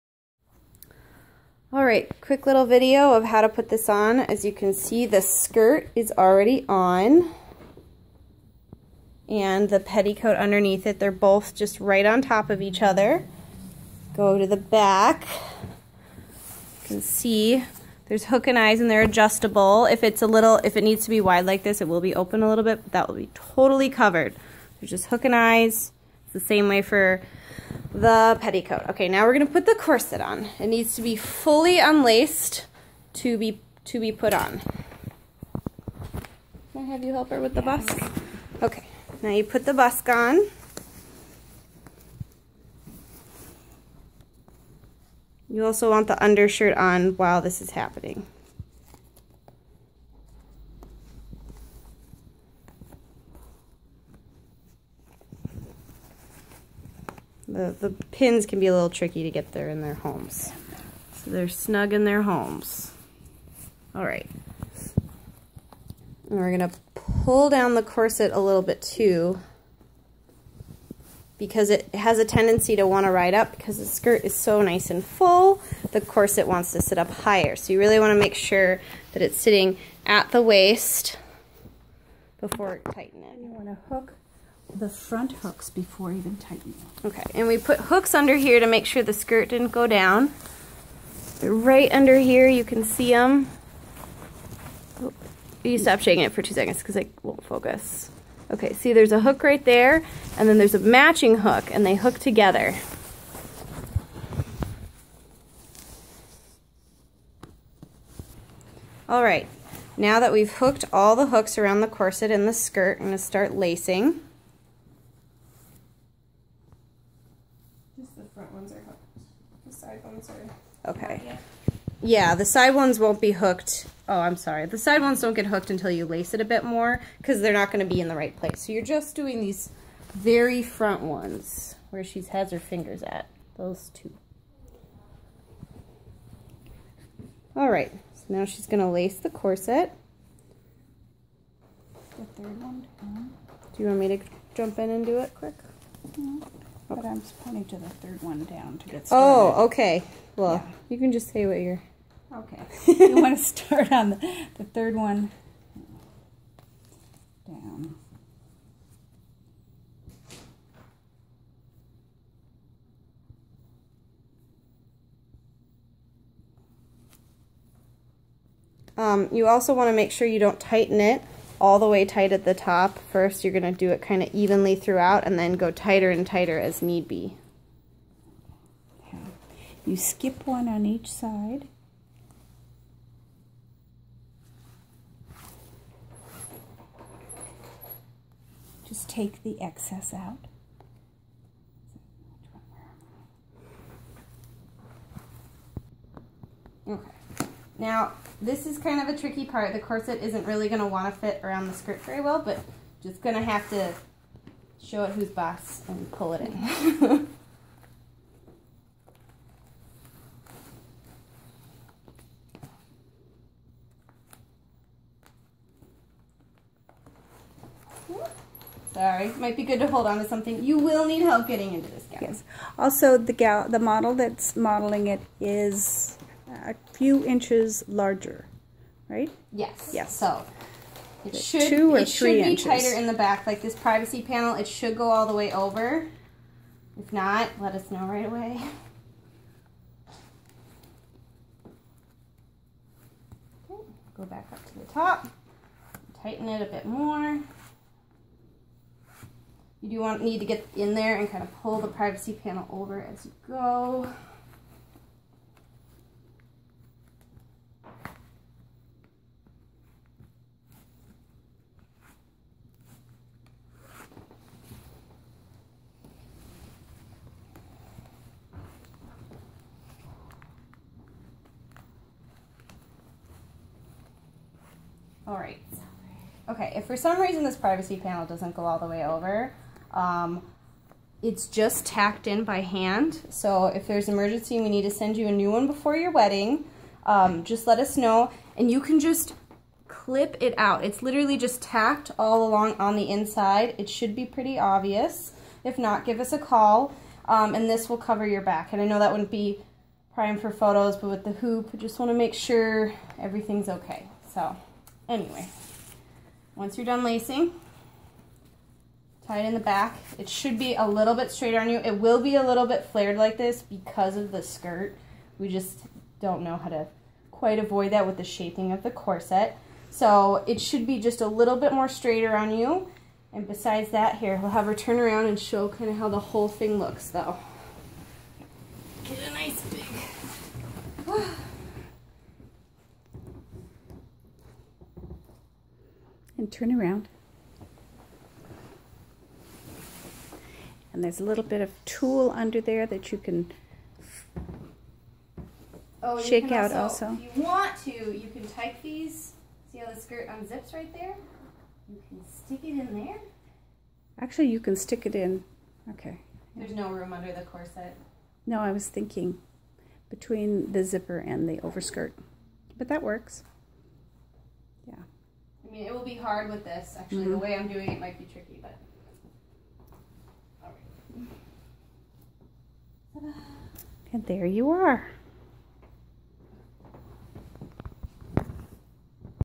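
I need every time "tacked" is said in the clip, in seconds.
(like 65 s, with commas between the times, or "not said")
281 s, 291 s.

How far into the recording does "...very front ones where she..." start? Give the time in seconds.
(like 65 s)
130 s.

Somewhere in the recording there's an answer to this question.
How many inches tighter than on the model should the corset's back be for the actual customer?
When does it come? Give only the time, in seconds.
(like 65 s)
231 s.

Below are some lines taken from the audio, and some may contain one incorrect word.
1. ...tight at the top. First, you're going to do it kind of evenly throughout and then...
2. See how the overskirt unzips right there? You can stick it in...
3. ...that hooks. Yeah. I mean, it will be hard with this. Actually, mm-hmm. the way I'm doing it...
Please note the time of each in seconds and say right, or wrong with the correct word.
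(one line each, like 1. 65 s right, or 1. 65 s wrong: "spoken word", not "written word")
1. 172 s right
2. 349 s wrong: "skirt", not "overskirt"
3. 362 s wrong: "works", not "hooks".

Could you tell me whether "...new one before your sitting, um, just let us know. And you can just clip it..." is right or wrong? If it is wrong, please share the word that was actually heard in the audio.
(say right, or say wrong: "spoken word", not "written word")
wrong: "wedding", not "sitting".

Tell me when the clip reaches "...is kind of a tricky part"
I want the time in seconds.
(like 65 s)
198 s.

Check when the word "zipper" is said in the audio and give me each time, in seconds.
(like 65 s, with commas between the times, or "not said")
360 s.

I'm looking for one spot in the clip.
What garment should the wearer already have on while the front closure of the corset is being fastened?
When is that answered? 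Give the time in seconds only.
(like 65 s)
46 s.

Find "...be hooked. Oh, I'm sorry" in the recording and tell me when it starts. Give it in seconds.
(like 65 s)
123 s.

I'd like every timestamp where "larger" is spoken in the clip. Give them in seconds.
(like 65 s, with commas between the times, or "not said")
227 s.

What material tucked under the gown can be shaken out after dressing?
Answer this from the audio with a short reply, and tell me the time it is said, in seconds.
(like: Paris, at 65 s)
Tulle, at 341 s.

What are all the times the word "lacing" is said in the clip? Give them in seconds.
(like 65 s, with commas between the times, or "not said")
113 s, 307 s.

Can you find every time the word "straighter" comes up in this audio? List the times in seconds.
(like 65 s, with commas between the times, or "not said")
311 s, 321 s.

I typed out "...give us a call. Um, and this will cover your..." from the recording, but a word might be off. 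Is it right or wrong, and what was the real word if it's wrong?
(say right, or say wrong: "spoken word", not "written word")
right.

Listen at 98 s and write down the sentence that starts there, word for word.
Okay, see there's a hook right there, and then there's a matching hook, and they hook together.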